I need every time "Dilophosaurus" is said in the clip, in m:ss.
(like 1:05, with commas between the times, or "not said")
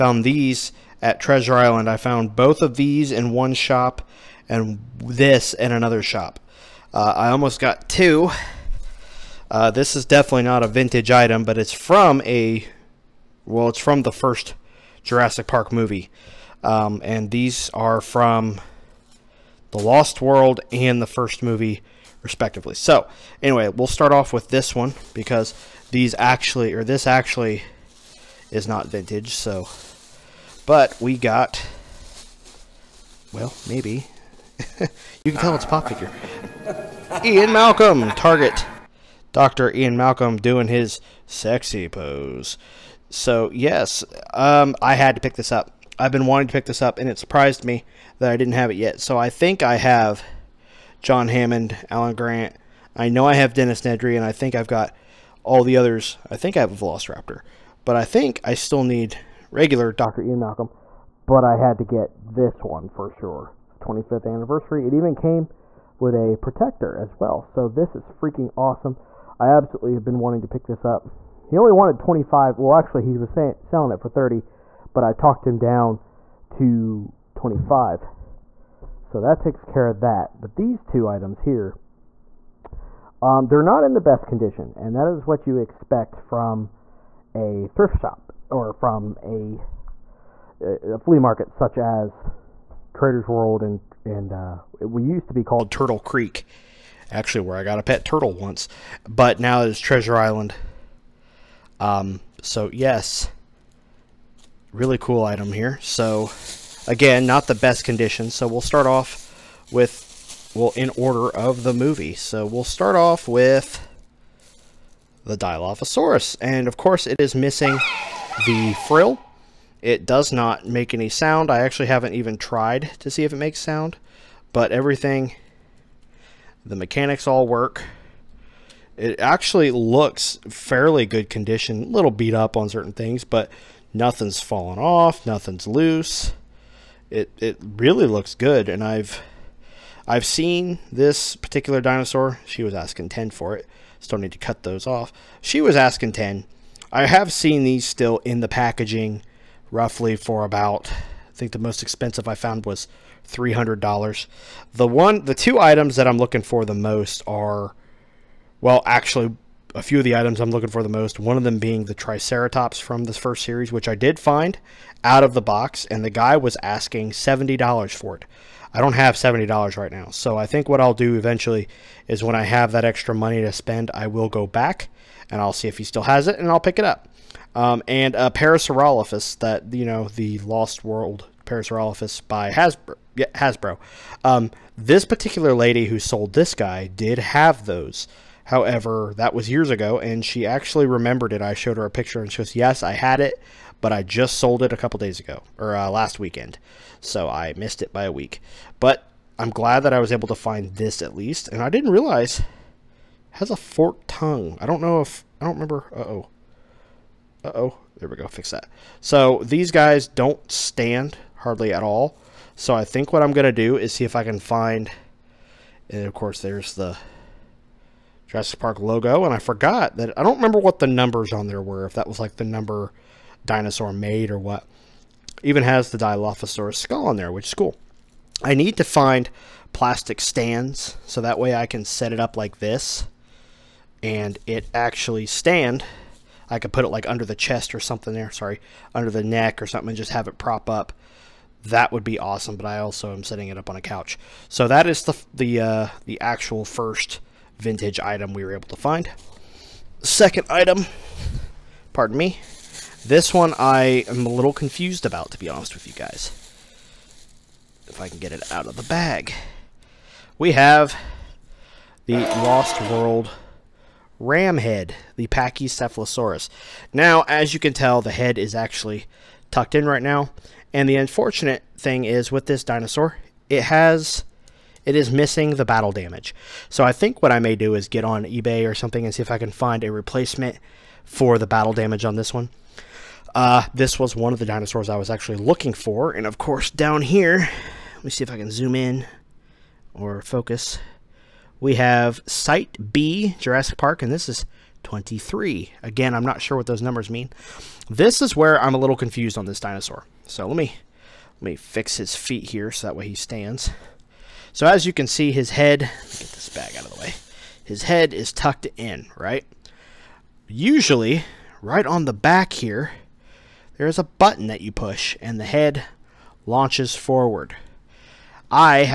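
1:55, 3:45.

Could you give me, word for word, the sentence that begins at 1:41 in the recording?
Um, so yes, really cool item here.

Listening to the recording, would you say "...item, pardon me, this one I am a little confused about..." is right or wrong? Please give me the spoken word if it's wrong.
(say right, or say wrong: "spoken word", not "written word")
right.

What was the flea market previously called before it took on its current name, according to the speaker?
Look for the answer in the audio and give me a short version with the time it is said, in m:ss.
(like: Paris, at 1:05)
Turtle Creek, at 1:35.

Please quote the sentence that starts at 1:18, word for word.
So that takes care of that.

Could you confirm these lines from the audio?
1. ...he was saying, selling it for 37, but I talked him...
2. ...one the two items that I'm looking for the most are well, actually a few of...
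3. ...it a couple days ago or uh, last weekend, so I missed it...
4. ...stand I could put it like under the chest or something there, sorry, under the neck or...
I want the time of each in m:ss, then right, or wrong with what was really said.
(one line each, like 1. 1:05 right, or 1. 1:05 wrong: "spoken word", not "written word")
1. 1:13 wrong: "30", not "37"
2. 2:34 right
3. 3:14 right
4. 3:55 right.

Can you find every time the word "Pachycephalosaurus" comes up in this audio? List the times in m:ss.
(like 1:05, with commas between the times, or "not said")
4:25.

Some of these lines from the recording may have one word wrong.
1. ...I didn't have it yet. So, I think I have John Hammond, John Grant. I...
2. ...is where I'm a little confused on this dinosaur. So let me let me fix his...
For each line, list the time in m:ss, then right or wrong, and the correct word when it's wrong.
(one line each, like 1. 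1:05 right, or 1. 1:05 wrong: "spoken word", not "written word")
1. 0:48 wrong: "Alan", not "John"
2. 4:58 right.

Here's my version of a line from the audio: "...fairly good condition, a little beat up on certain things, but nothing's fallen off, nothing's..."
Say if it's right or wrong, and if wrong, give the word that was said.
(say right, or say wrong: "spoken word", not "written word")
right.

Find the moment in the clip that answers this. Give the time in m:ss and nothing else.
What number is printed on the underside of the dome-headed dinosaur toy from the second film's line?
4:54.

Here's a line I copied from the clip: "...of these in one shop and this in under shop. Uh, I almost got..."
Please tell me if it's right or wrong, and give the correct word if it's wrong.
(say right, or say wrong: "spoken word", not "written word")
wrong: "another", not "under".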